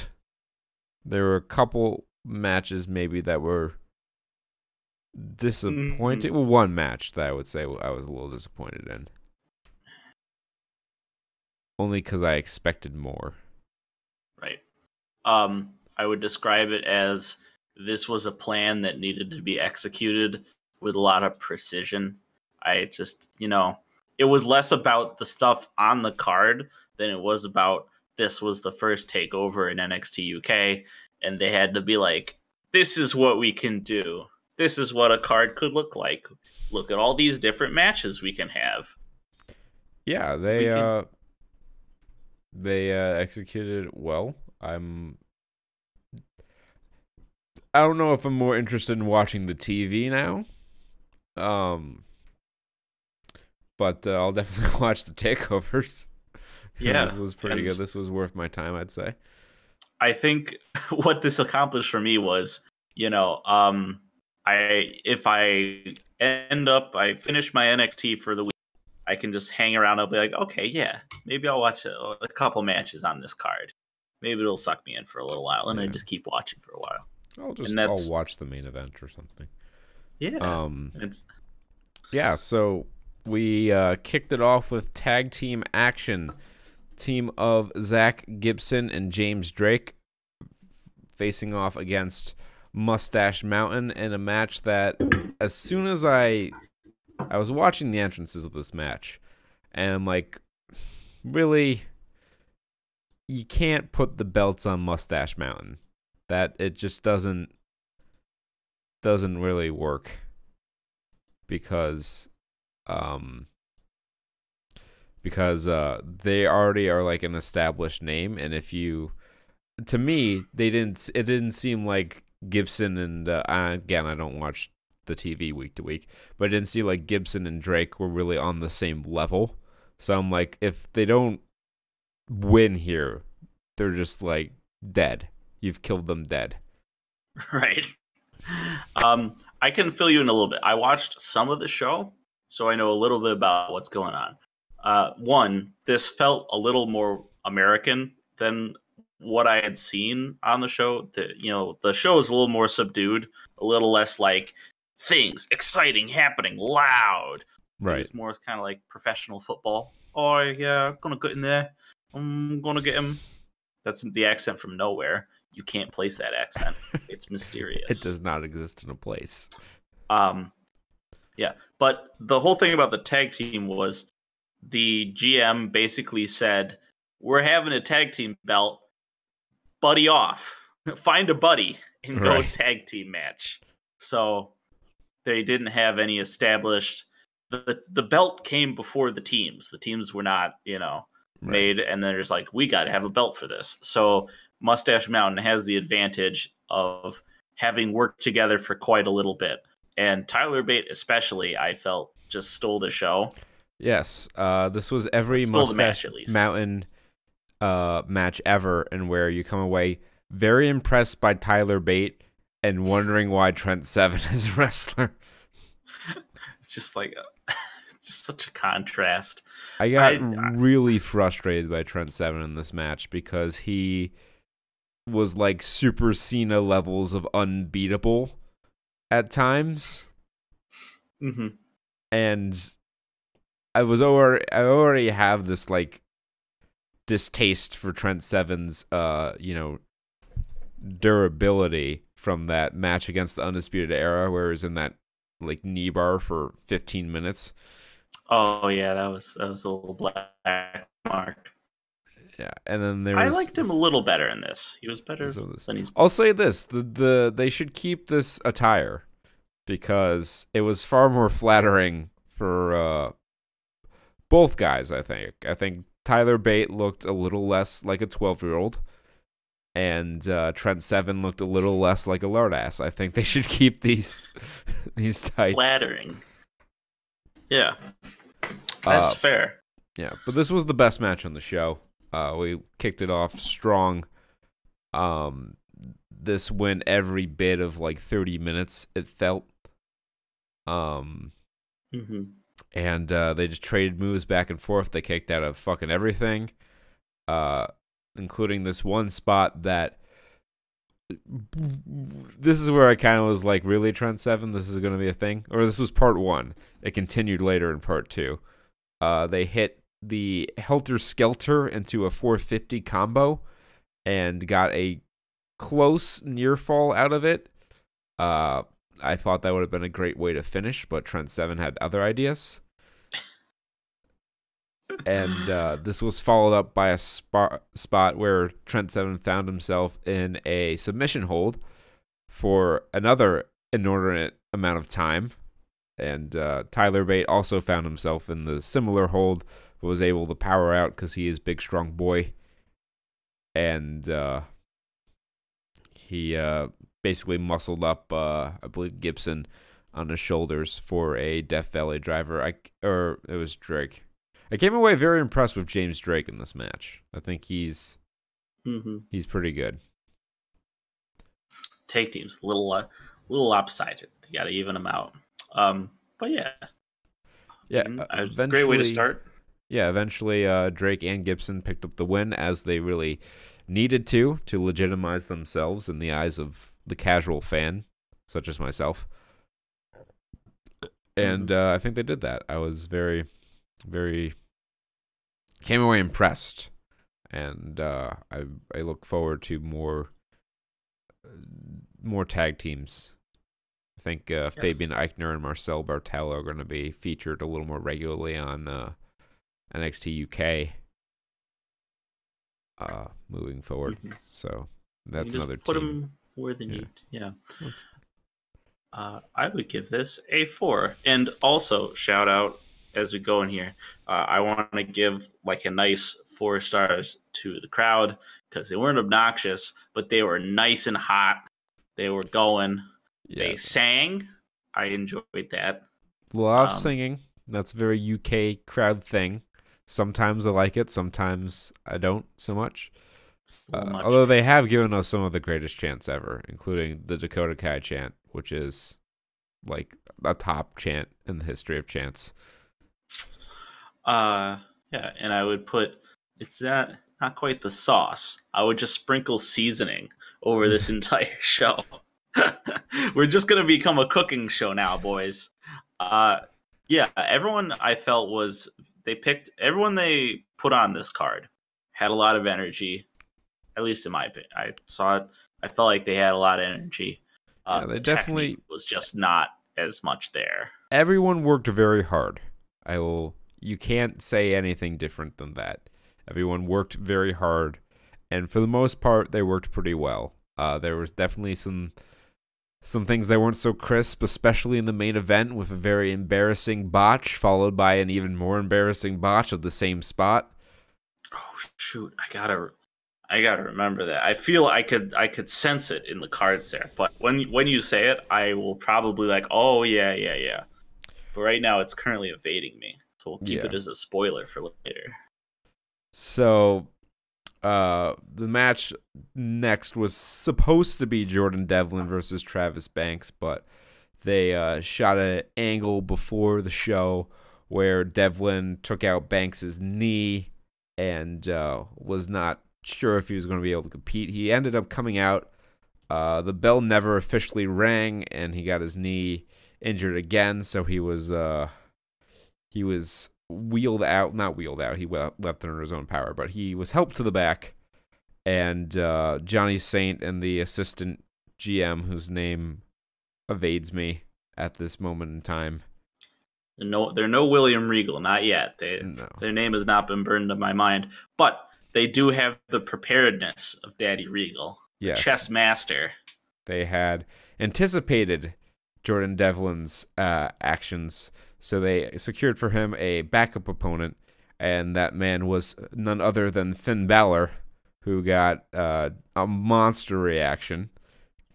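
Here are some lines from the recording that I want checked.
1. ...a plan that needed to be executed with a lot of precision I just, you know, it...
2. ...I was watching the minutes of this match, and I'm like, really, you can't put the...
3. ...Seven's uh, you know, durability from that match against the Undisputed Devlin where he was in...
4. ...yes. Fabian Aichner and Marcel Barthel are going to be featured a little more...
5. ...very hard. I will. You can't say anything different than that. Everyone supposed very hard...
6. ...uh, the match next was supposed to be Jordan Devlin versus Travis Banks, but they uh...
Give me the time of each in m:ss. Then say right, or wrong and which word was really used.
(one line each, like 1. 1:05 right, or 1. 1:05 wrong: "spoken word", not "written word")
1. 0:18 right
2. 1:37 wrong: "entrances", not "minutes"
3. 3:58 wrong: "Era", not "Devlin"
4. 6:34 right
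5. 7:51 wrong: "worked", not "supposed"
6. 8:27 right.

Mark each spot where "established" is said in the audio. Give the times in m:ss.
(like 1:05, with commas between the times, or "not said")
1:57, 3:06.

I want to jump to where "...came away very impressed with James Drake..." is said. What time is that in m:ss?
5:54.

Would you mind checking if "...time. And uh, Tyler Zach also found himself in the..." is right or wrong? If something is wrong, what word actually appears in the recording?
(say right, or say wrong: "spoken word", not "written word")
wrong: "Bate", not "Zach".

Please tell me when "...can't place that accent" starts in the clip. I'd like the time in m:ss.
2:45.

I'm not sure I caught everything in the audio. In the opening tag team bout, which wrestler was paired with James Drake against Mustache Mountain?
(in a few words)
Zach Gibson.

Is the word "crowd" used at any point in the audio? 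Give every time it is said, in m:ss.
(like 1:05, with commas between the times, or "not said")
6:57, 7:08.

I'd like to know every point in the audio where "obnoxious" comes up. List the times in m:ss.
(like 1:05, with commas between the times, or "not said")
6:58.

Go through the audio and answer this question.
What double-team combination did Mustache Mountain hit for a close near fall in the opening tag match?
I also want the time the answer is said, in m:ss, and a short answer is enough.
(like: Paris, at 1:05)
Helter Skelter into a 450, at 5:10.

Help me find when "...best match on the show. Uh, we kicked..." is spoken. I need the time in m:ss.
4:40.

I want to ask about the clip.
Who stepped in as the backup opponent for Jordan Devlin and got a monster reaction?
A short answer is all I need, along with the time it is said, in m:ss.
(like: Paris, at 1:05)
Finn Balor, at 9:26.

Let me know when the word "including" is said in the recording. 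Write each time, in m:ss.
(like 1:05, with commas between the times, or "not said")
4:58, 7:16.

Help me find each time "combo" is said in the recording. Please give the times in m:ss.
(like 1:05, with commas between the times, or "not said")
5:12.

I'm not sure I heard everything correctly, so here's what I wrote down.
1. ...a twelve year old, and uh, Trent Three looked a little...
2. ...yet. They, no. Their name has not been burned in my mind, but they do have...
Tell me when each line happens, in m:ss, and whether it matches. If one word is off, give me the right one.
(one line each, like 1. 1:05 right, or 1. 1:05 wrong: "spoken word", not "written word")
1. 4:28 wrong: "Seven", not "Three"
2. 9:08 right.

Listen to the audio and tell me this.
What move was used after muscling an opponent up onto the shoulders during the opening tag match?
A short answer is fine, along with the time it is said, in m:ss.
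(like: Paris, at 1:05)
Death Valley driver, at 5:51.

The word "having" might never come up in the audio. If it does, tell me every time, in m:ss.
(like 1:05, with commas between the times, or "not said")
2:57, 3:17.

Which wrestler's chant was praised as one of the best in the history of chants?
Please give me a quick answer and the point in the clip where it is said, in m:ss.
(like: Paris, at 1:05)
Dakota Kai, at 7:17.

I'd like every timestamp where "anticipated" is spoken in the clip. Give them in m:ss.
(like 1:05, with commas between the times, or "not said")
9:17.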